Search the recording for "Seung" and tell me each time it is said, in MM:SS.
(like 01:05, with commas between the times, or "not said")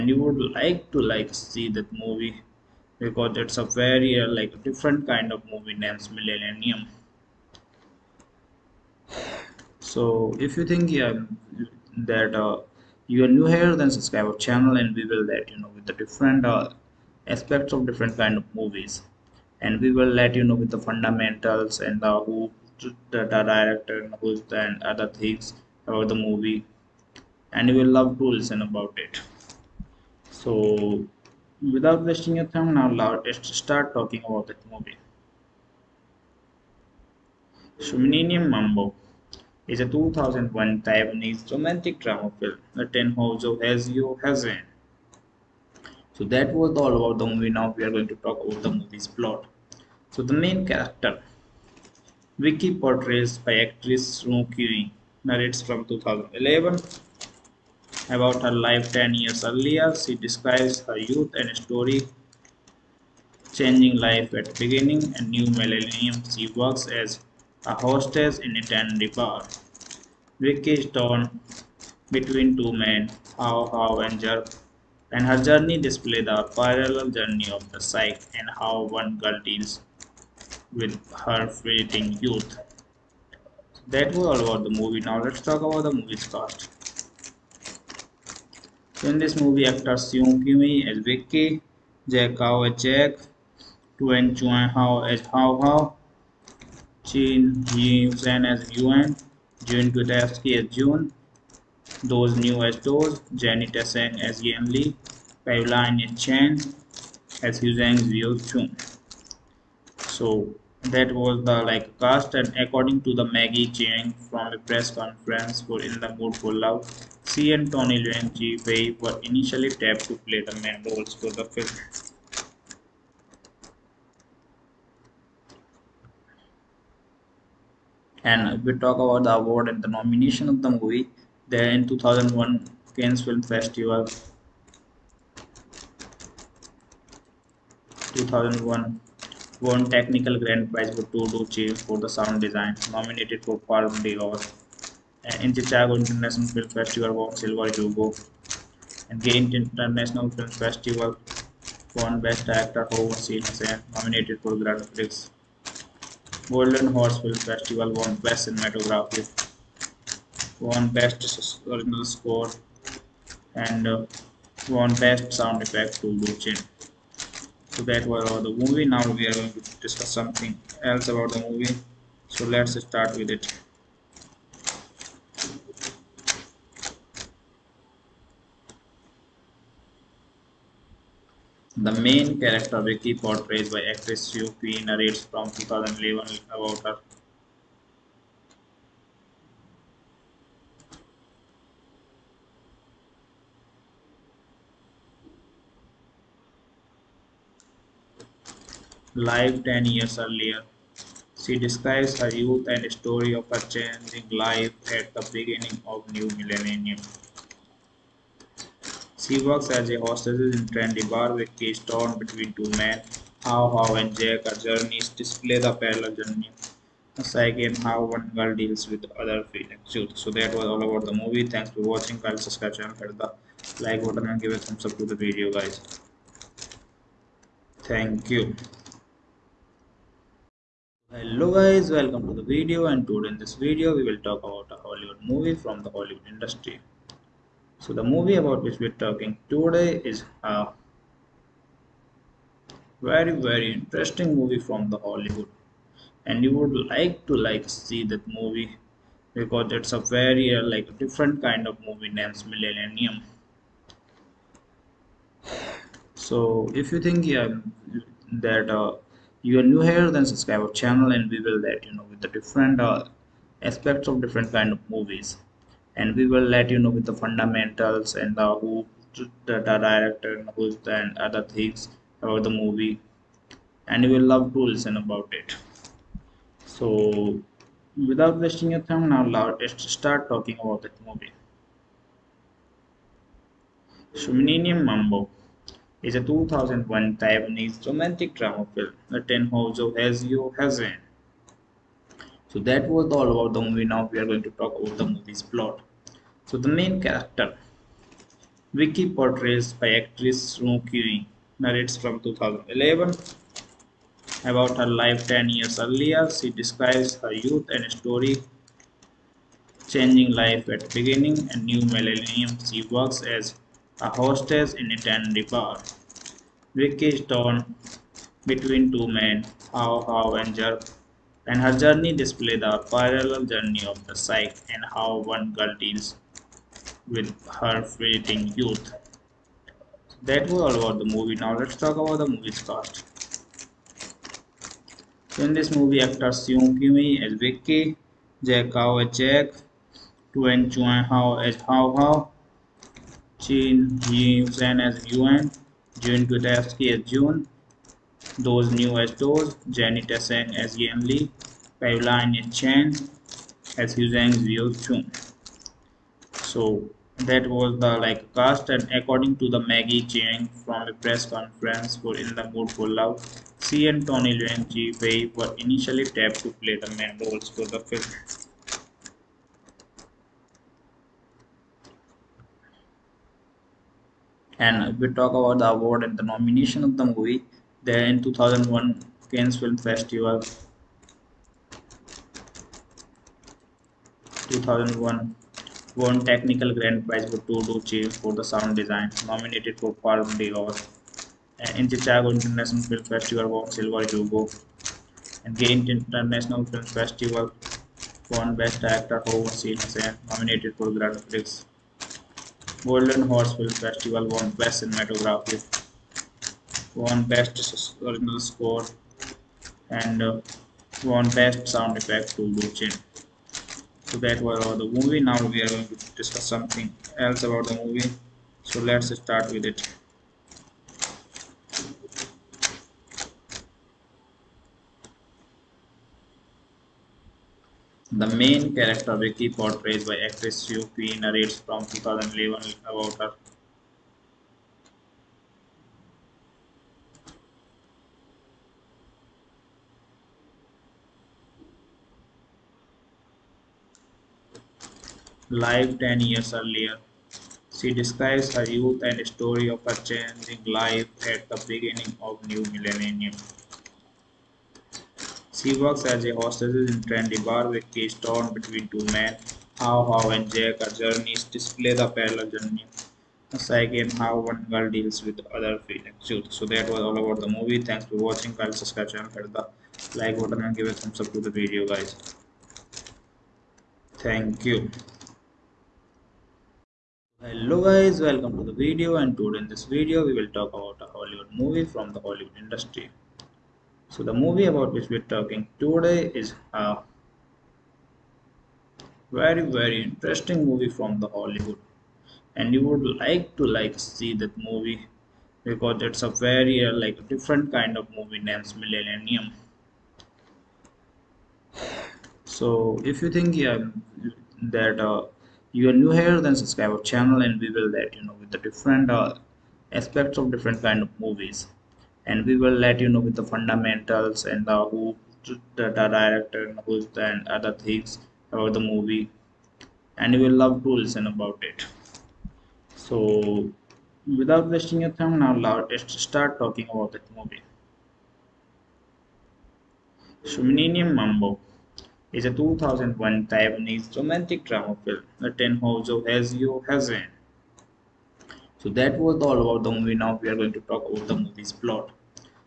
01:30, 05:36.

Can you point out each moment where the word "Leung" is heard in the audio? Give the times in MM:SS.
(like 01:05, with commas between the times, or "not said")
01:58, 06:04.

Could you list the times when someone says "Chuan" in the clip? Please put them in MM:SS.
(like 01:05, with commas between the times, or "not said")
01:34, 05:40.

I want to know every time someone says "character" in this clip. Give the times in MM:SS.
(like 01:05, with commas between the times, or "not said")
00:50, 03:02, 04:57, 07:08.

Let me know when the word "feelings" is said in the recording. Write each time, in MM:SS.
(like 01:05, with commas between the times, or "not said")
03:39, 07:45.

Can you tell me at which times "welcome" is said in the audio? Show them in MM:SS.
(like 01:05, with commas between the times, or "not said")
03:51, 07:58.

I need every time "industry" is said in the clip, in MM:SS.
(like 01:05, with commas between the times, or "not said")
03:56, 08:02.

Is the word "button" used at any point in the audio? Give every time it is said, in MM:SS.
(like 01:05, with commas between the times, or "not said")
03:44, 07:50.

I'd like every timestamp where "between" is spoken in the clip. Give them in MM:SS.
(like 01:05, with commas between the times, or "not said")
01:12, 03:32, 05:18, 07:38.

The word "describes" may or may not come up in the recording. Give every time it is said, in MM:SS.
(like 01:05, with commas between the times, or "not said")
01:00, 03:21, 05:06, 07:27.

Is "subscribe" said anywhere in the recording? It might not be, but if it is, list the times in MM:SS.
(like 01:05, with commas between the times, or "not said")
00:13, 03:42, 04:20, 07:48, 08:26.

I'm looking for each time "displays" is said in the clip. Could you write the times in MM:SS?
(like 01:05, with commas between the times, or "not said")
01:15, 03:35, 05:22, 07:41.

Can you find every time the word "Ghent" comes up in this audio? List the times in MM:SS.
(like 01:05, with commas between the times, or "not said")
02:29, 06:35.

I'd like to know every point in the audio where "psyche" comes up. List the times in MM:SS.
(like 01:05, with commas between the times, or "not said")
01:17, 03:37, 05:24, 07:43.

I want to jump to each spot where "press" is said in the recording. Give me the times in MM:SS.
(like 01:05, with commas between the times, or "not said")
01:54, 06:00.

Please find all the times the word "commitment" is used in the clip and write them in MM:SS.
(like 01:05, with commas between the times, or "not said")
not said.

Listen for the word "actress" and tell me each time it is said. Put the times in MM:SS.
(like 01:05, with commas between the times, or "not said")
00:53, 03:03, 05:00, 07:10.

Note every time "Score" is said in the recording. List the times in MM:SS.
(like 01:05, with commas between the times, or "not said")
02:42, 06:48.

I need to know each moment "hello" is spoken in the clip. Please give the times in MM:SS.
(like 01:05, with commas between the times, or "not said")
03:51, 07:57.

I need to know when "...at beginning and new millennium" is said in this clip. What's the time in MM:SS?
05:10.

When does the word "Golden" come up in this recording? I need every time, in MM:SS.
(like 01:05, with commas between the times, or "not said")
02:36, 06:42.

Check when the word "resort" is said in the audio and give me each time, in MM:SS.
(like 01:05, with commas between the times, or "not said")
not said.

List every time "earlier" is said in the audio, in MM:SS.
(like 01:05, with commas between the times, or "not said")
00:59, 03:20, 05:05, 07:26.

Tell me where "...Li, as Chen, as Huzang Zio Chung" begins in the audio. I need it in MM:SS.
01:44.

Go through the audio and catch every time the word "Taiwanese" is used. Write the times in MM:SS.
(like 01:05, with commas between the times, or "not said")
00:40, 04:47, 08:53.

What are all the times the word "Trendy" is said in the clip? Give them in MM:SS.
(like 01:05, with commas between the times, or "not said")
03:30, 07:37.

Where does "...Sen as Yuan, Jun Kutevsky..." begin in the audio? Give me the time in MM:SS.
01:38.